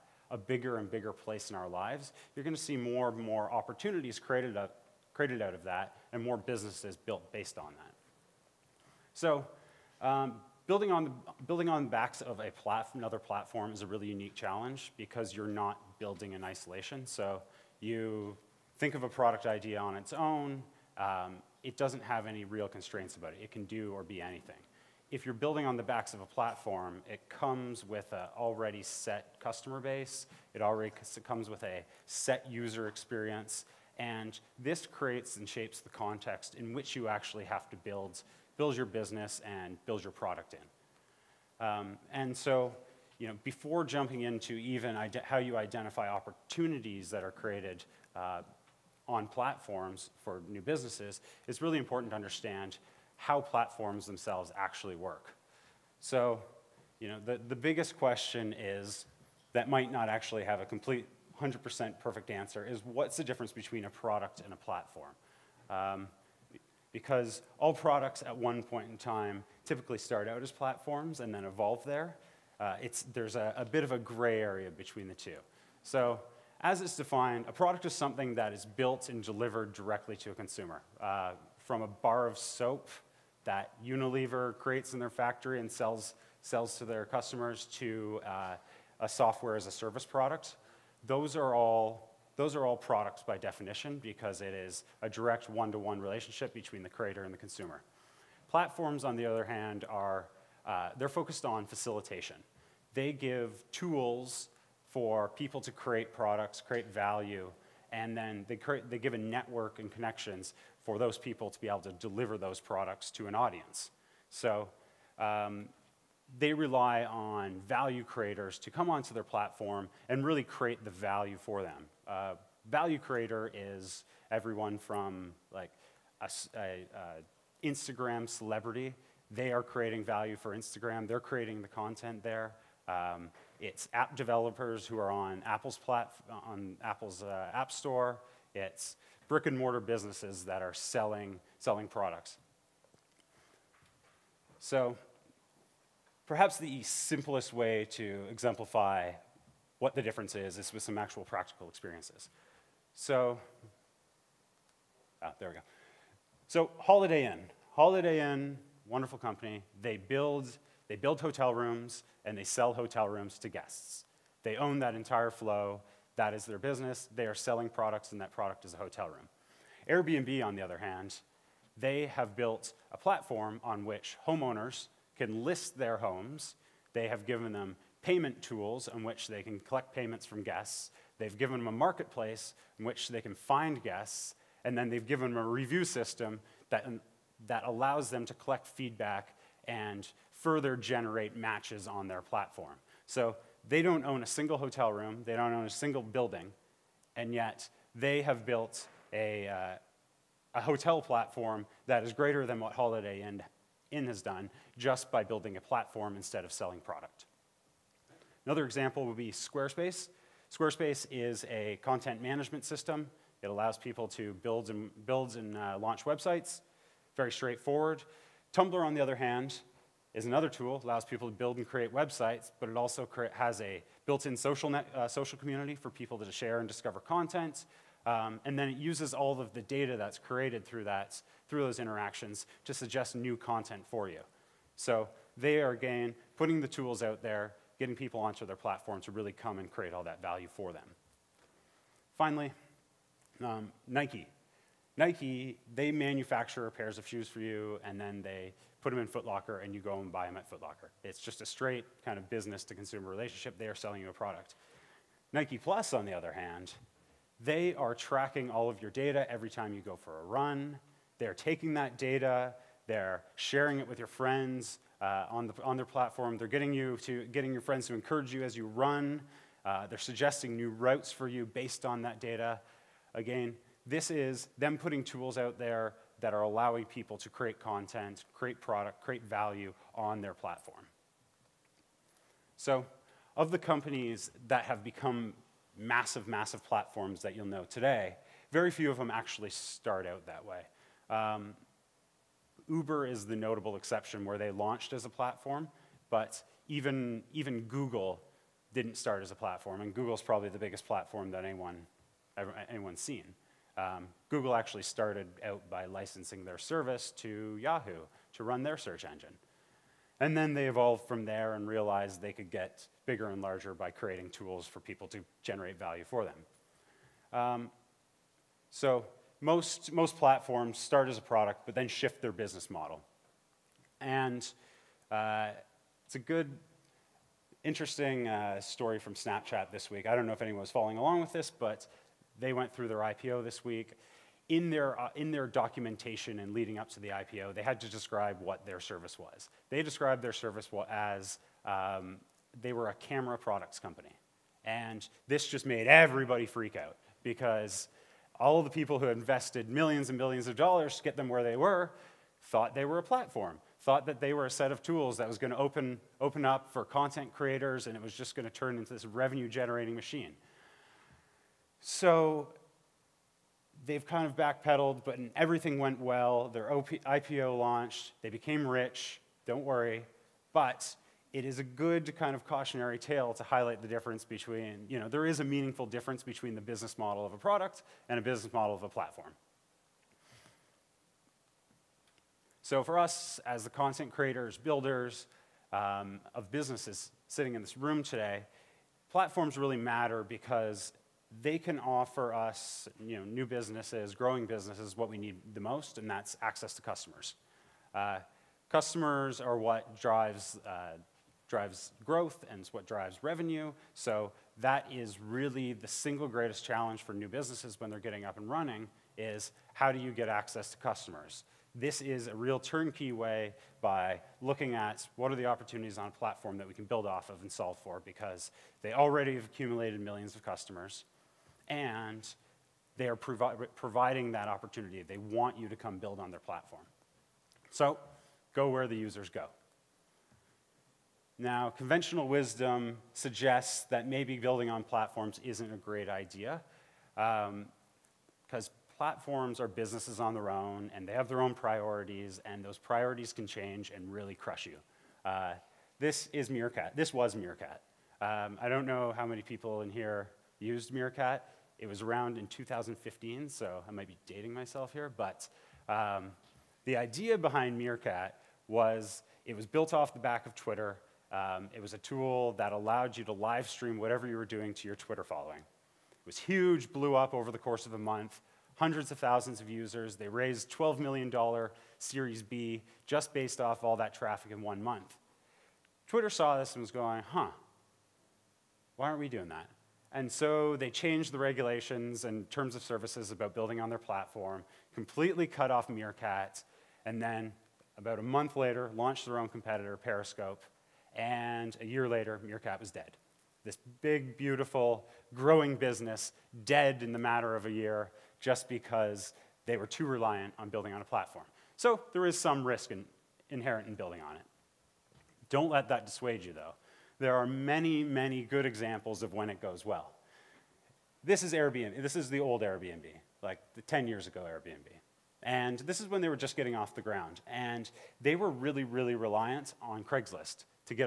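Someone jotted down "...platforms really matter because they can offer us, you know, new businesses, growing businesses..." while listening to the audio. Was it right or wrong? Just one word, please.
right.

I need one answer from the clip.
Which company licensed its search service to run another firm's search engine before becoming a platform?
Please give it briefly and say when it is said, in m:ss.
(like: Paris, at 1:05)
Yahoo, at 5:07.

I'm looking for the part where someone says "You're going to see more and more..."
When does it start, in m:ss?
0:02.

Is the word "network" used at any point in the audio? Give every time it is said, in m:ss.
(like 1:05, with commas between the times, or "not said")
1:49.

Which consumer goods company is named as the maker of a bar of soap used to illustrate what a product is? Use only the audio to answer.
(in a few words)
Unilever.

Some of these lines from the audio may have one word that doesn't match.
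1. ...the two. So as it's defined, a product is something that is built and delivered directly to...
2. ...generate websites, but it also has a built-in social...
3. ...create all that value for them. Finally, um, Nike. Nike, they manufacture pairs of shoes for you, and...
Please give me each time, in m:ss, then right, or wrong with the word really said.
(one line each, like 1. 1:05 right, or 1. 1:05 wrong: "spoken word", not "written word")
1. 1:15 right
2. 3:41 wrong: "create", not "generate"
3. 3:59 right.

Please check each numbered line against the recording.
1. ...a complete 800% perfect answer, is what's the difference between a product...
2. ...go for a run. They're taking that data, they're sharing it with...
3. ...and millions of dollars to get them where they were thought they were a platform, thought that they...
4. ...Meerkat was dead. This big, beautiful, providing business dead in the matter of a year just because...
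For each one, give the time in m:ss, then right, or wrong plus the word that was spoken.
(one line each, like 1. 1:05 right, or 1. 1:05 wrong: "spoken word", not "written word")
1. 1:00 wrong: "100", not "800"
2. 4:19 right
3. 5:50 right
4. 8:12 wrong: "growing", not "providing".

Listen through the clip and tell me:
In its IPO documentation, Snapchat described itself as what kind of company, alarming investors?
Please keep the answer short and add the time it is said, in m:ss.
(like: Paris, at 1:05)
a camera products company, at 5:42.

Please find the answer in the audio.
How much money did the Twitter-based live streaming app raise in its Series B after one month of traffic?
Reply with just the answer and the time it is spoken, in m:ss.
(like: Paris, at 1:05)
$12 million, at 7:50.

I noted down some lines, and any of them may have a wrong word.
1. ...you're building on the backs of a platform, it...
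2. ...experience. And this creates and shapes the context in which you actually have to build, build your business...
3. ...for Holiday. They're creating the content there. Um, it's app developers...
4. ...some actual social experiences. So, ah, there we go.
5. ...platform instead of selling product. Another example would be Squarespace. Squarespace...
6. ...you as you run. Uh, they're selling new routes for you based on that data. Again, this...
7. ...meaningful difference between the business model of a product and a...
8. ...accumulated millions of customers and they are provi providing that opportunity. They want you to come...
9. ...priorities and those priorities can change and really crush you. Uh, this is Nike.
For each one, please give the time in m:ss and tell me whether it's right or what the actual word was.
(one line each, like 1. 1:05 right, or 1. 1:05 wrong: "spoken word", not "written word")
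1. 0:25 right
2. 0:32 right
3. 2:10 wrong: "Instagram", not "Holiday"
4. 2:30 wrong: "practical", not "social"
5. 3:25 right
6. 4:28 wrong: "suggesting", not "selling"
7. 6:15 right
8. 6:59 right
9. 7:21 wrong: "Meerkat", not "Nike".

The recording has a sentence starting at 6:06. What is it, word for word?
Their OP, IPO launched, they became rich, don't worry.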